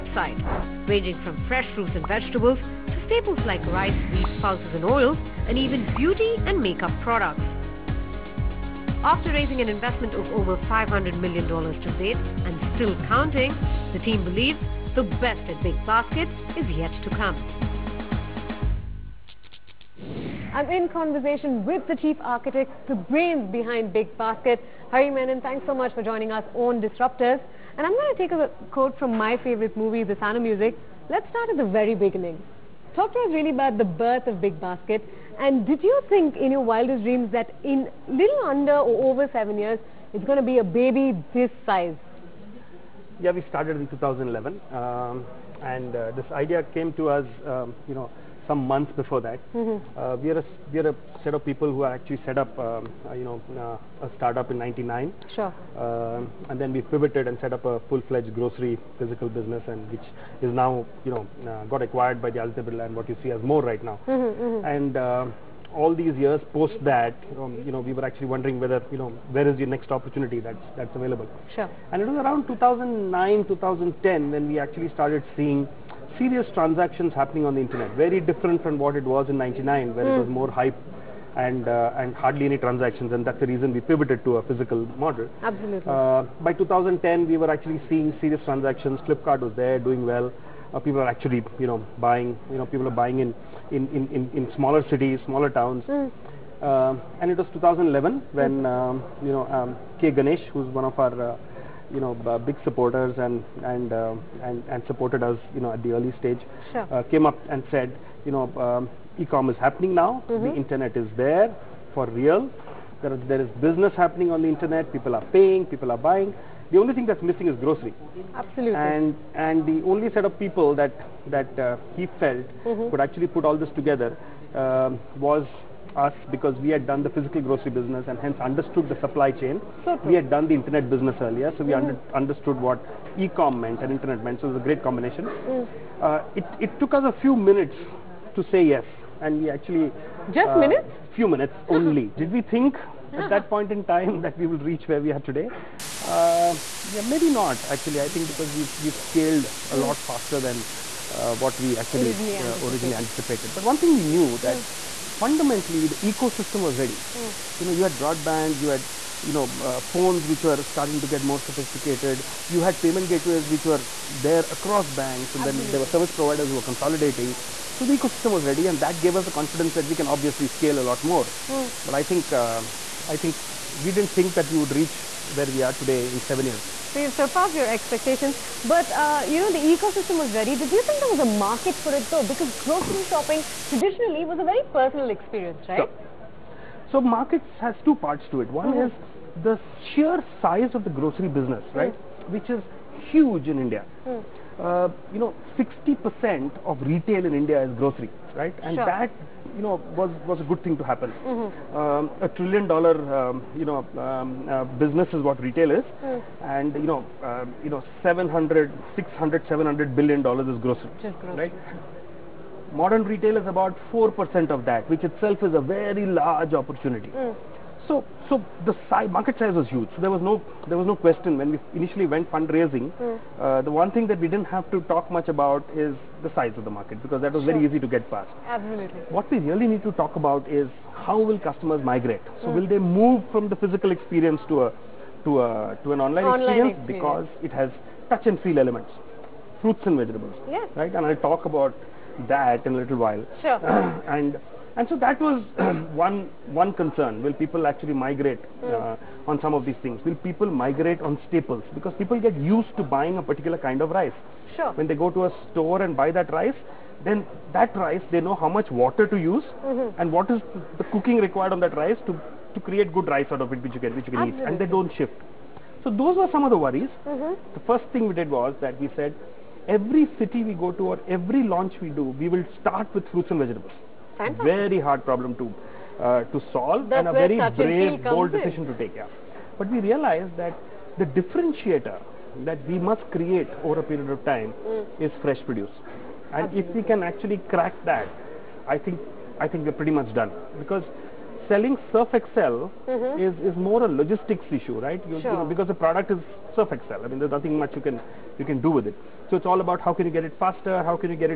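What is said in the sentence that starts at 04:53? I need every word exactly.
is, is more a logistics issue, right?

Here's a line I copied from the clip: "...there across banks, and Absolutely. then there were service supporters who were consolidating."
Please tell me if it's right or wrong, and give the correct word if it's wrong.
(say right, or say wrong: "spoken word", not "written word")
wrong: "providers", not "supporters".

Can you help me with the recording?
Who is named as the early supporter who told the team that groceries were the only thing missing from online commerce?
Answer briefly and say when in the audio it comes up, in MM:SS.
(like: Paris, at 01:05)
K Ganesh, at 01:40.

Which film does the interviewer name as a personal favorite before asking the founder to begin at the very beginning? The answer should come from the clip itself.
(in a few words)
The Sound of Music.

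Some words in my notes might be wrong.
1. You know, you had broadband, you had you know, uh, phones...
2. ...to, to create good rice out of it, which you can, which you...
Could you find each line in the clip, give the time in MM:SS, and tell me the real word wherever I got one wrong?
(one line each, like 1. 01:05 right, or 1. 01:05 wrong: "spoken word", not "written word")
1. 02:37 right
2. 04:22 right.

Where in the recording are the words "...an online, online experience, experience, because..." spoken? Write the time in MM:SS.
03:55.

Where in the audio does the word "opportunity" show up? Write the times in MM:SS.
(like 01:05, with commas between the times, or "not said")
01:09, 03:36.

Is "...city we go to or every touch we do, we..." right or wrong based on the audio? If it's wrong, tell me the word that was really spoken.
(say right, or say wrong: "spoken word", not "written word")
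wrong: "launch", not "touch".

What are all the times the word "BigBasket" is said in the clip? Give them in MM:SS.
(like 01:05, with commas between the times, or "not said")
00:23, 00:34.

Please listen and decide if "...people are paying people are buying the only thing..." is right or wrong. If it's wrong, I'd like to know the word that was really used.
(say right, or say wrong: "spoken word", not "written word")
right.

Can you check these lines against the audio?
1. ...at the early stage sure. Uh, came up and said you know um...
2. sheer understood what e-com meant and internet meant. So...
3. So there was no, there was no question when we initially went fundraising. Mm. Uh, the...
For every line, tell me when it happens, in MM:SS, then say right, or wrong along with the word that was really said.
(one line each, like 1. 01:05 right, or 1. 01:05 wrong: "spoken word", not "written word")
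1. 01:45 right
2. 02:11 wrong: "under", not "sheer"
3. 03:39 right.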